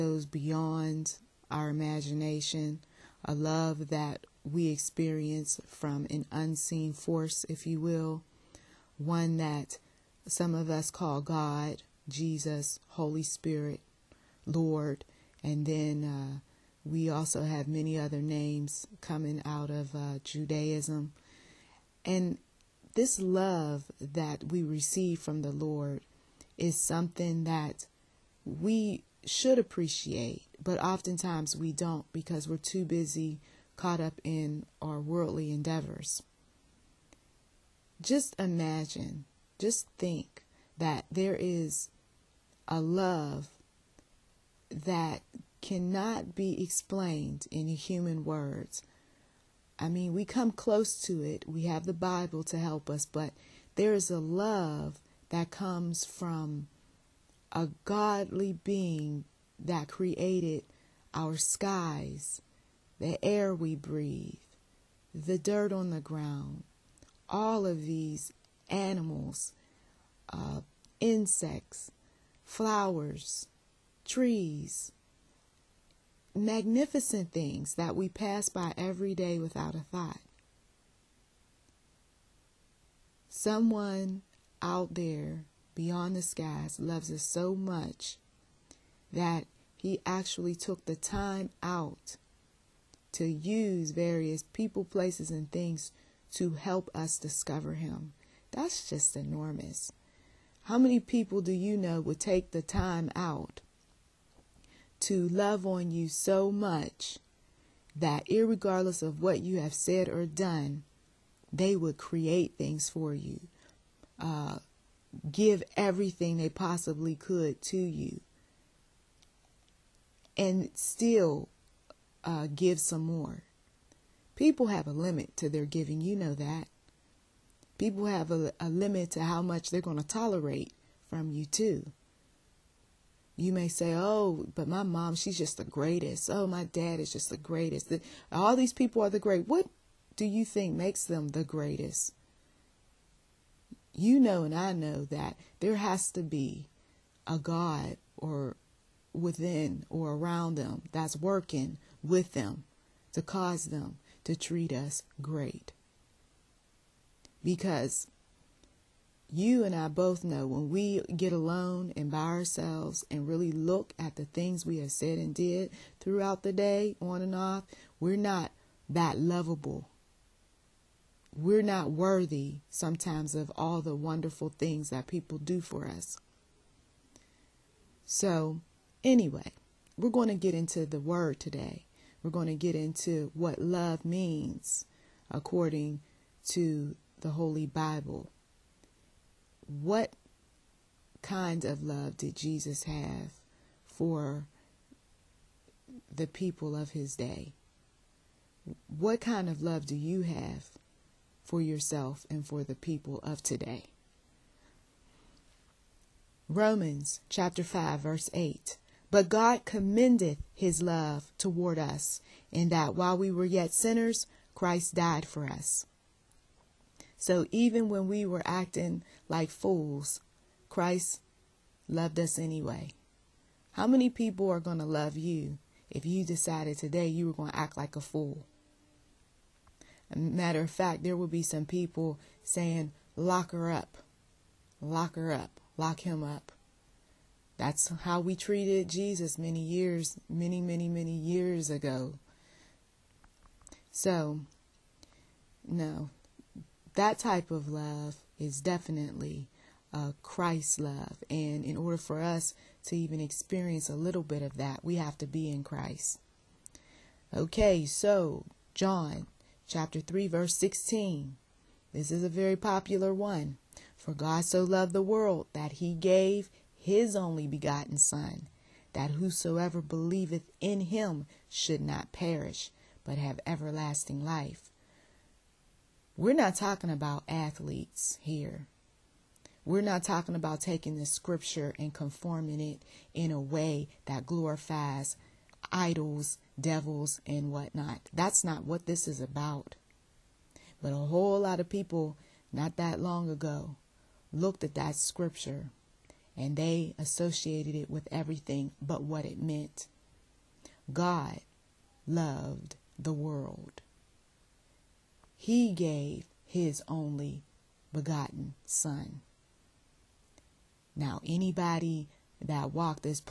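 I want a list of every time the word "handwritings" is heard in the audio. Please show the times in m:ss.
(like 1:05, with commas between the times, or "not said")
not said.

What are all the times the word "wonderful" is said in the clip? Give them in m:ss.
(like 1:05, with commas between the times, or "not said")
2:53.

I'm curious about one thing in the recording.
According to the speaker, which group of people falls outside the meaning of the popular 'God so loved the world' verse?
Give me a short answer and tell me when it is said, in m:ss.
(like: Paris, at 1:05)
athletes, at 4:37.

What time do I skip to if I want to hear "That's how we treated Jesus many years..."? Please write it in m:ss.
3:57.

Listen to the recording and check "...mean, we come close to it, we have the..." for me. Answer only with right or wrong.
right.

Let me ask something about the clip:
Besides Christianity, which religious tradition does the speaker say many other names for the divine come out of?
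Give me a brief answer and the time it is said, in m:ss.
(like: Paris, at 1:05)
Judaism, at 0:20.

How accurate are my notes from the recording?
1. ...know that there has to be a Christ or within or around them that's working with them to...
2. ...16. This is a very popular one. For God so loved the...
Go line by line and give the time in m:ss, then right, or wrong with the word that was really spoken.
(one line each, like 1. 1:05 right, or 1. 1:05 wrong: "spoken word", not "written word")
1. 2:24 wrong: "God", not "Christ"
2. 4:20 right.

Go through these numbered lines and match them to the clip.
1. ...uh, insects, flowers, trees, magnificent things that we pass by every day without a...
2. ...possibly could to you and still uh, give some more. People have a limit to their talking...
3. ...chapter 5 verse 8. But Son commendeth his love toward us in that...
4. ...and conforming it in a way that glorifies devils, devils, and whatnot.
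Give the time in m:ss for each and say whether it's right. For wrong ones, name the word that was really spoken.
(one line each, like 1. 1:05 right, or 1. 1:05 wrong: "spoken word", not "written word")
1. 1:10 right
2. 1:56 wrong: "giving", not "talking"
3. 3:27 wrong: "God", not "Son"
4. 4:41 wrong: "idols", not "devils".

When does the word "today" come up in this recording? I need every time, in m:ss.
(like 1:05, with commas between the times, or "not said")
3:01, 3:23, 3:46.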